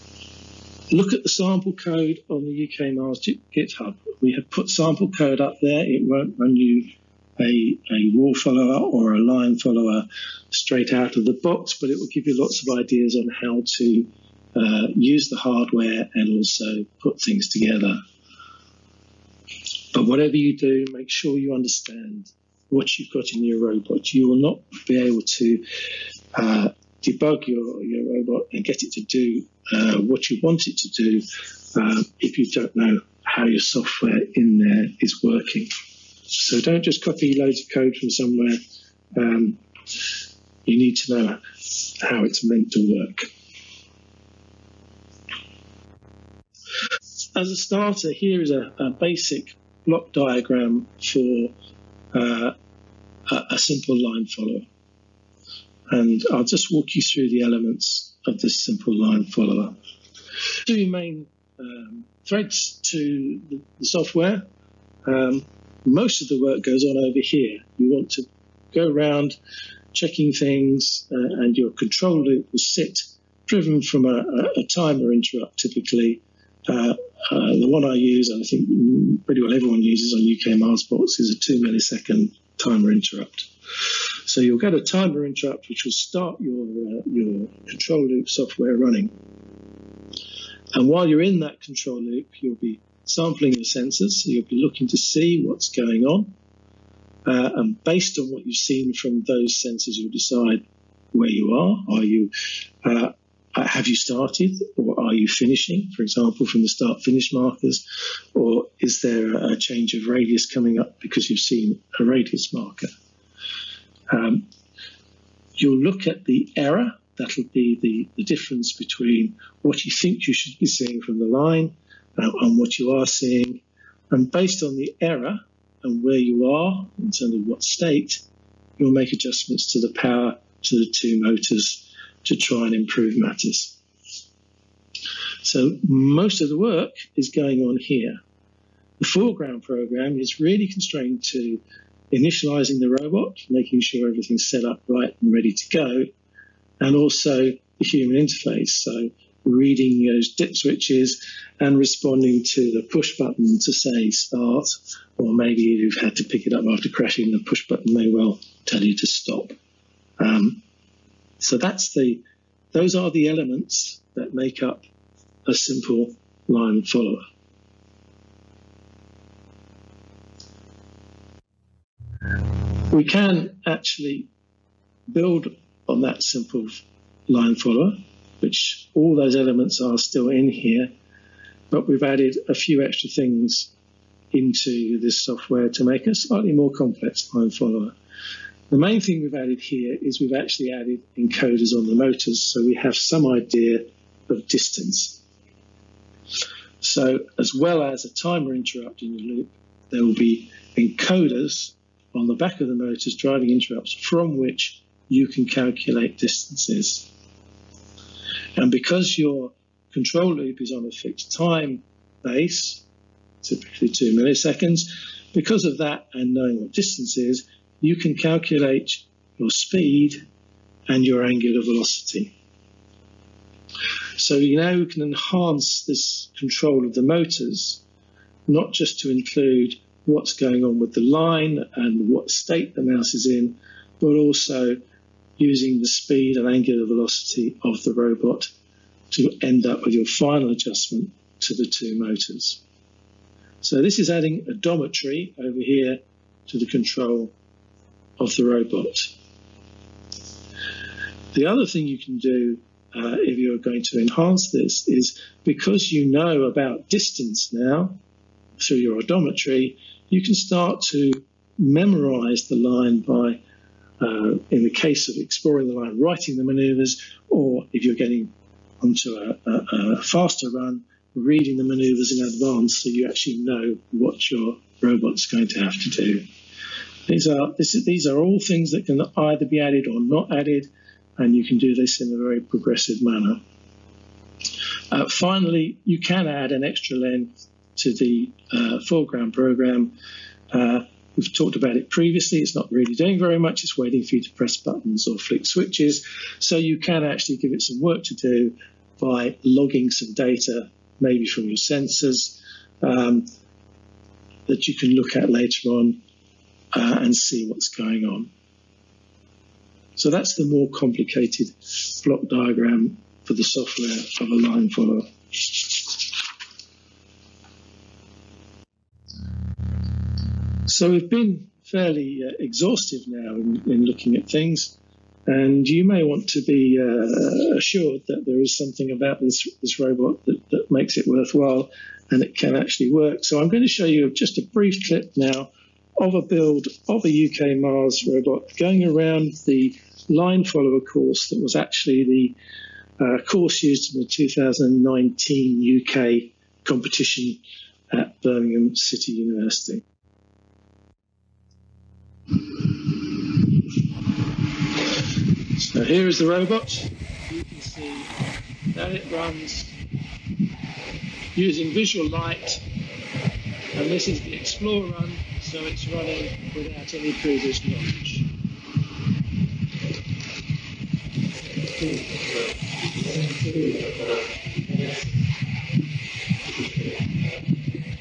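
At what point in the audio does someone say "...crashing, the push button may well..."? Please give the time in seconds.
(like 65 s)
156 s.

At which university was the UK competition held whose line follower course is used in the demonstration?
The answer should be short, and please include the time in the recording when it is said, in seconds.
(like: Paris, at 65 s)
Birmingham City University, at 348 s.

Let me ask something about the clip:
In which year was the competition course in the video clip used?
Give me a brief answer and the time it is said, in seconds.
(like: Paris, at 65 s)
2019, at 344 s.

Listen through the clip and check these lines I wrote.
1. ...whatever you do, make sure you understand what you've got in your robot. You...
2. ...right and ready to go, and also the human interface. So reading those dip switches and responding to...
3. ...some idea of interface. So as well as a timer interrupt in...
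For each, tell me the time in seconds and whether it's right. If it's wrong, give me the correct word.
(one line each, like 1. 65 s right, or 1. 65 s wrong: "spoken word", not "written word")
1. 20 s right
2. 144 s right
3. 192 s wrong: "distance", not "interface".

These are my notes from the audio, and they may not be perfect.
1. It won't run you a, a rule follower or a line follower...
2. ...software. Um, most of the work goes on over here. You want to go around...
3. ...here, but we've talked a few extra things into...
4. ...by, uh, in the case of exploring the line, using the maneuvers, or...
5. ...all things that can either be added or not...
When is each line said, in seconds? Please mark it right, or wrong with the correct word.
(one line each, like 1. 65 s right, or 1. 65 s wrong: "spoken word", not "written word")
1. 5 s right
2. 63 s right
3. 180 s wrong: "added", not "talked"
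4. 263 s wrong: "writing", not "using"
5. 278 s right.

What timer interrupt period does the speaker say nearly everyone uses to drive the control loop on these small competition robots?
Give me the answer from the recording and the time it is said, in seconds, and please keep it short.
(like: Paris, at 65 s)
2 milliseconds, at 81 s.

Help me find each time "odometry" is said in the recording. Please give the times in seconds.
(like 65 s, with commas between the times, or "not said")
244 s, 259 s.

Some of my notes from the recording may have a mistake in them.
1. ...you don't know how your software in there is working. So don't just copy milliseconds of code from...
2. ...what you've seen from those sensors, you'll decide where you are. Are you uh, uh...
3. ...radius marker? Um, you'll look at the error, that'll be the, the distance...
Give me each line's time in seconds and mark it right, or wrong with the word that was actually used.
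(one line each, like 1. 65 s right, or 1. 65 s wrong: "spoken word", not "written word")
1. 32 s wrong: "loads", not "milliseconds"
2. 98 s right
3. 112 s wrong: "difference", not "distance".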